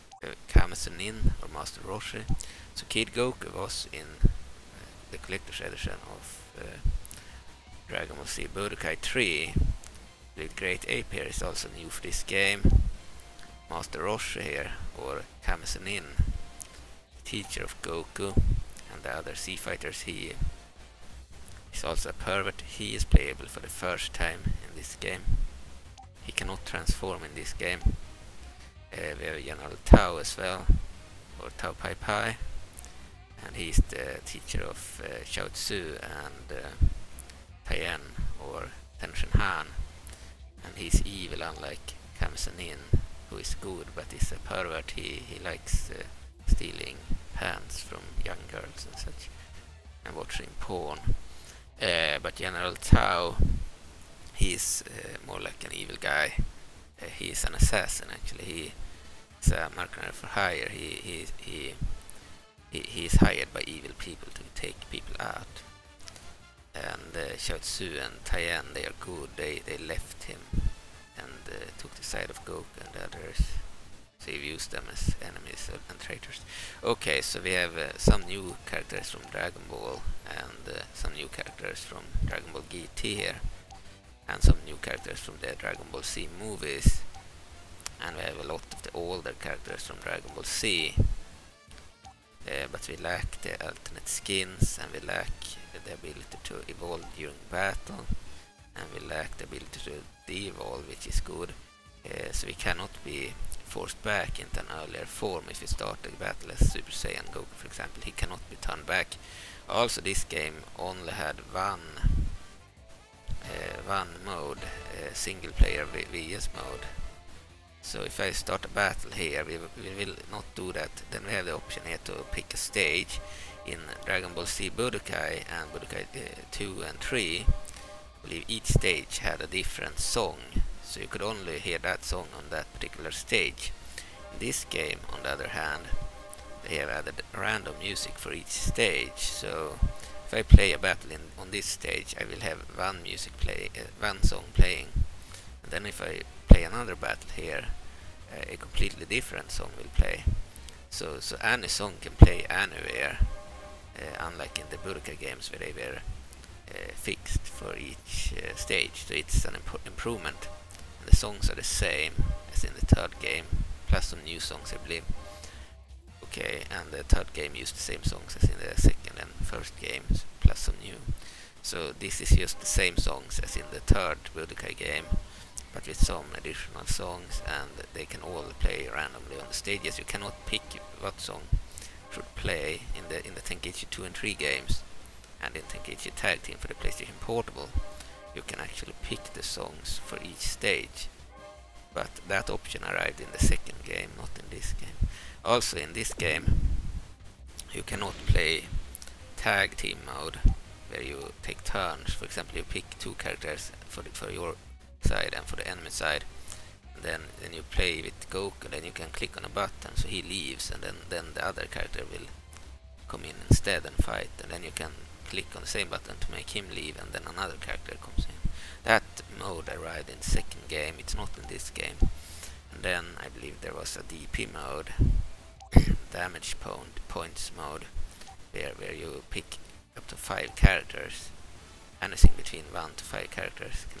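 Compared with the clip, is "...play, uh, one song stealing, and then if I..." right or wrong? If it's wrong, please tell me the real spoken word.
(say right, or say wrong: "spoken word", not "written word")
wrong: "playing", not "stealing".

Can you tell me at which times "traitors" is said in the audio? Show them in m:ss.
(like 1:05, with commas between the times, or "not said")
1:15.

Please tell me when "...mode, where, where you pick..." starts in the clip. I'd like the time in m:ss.
3:47.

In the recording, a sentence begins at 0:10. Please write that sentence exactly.
The Great Ape here is also new for this game.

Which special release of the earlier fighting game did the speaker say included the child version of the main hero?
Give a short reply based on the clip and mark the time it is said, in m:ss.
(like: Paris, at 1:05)
Collector's edition, at 0:05.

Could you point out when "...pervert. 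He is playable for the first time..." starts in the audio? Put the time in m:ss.
0:22.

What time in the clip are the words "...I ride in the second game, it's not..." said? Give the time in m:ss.
3:39.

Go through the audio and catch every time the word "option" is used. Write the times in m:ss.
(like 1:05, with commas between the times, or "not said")
2:01, 3:12.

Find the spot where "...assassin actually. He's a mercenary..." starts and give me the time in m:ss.
0:57.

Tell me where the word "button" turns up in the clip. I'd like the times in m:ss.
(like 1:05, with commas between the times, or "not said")
3:29, 3:35.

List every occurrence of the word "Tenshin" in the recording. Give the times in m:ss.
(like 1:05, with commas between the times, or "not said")
0:39.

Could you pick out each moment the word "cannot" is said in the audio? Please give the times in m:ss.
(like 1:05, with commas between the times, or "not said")
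0:26, 1:42, 1:48, 3:00, 3:17.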